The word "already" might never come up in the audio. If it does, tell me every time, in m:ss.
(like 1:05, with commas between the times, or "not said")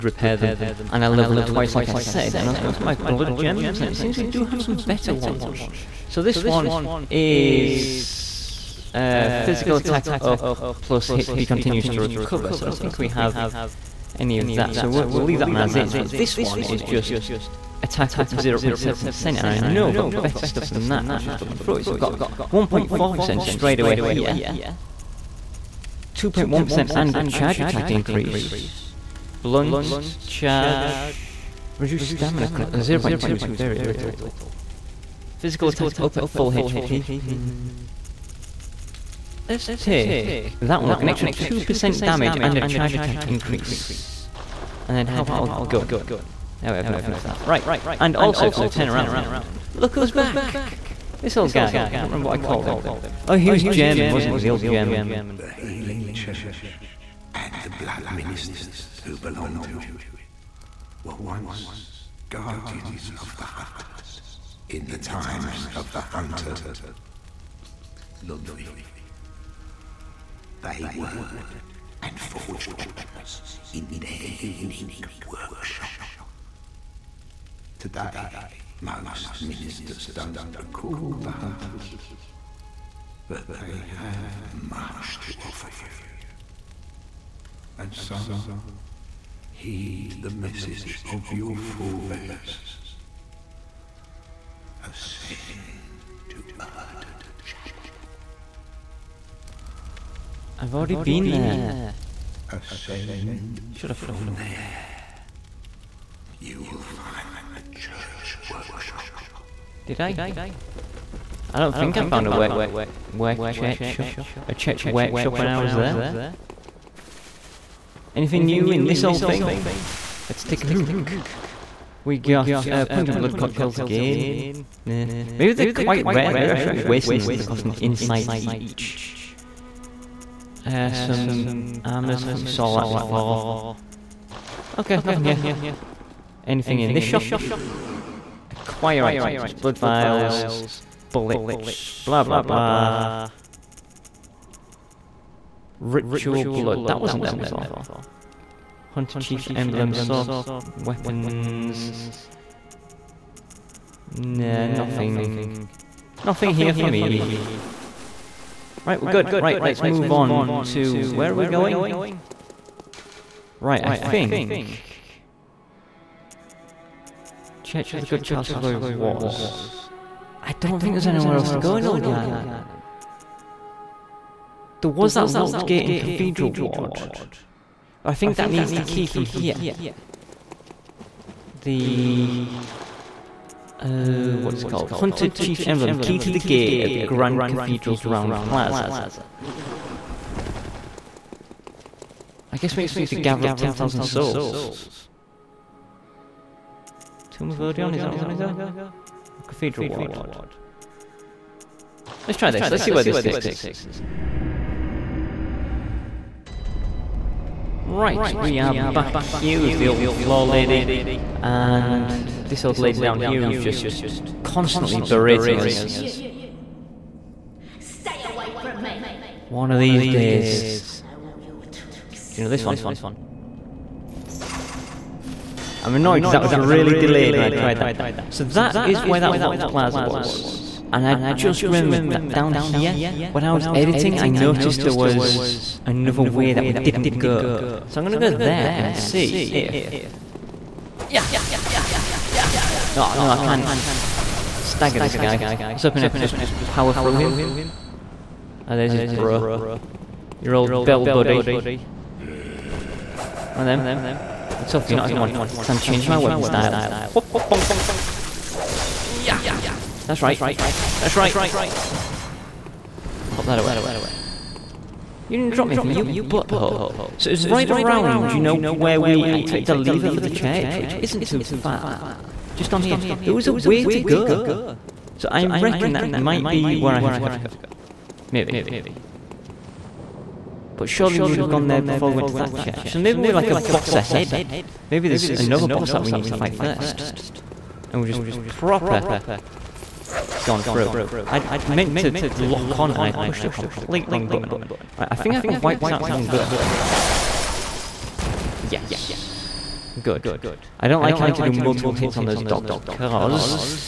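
1:40.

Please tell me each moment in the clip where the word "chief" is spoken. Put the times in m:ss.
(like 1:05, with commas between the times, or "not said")
2:29, 3:05.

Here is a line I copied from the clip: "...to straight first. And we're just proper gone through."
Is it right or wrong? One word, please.
wrong.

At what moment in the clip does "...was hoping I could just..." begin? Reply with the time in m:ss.
4:05.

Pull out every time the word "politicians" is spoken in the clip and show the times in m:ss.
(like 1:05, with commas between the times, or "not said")
not said.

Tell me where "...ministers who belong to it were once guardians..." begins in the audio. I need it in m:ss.
0:58.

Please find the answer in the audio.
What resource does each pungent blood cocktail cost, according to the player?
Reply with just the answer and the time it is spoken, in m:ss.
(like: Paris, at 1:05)
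Insight, at 2:07.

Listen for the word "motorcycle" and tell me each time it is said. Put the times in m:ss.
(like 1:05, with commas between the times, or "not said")
not said.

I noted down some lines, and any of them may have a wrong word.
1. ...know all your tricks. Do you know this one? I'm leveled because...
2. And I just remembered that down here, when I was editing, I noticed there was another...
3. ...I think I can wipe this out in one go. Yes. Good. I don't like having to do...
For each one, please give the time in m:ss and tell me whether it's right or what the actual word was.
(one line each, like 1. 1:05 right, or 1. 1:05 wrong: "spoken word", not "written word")
1. 3:40 wrong: "annoyed", not "leveled"
2. 3:50 right
3. 4:55 right.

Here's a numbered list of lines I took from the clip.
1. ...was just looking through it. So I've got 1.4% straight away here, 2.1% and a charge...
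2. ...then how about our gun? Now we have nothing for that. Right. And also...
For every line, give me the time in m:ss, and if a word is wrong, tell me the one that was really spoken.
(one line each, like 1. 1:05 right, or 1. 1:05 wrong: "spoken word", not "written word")
1. 0:21 right
2. 0:44 right.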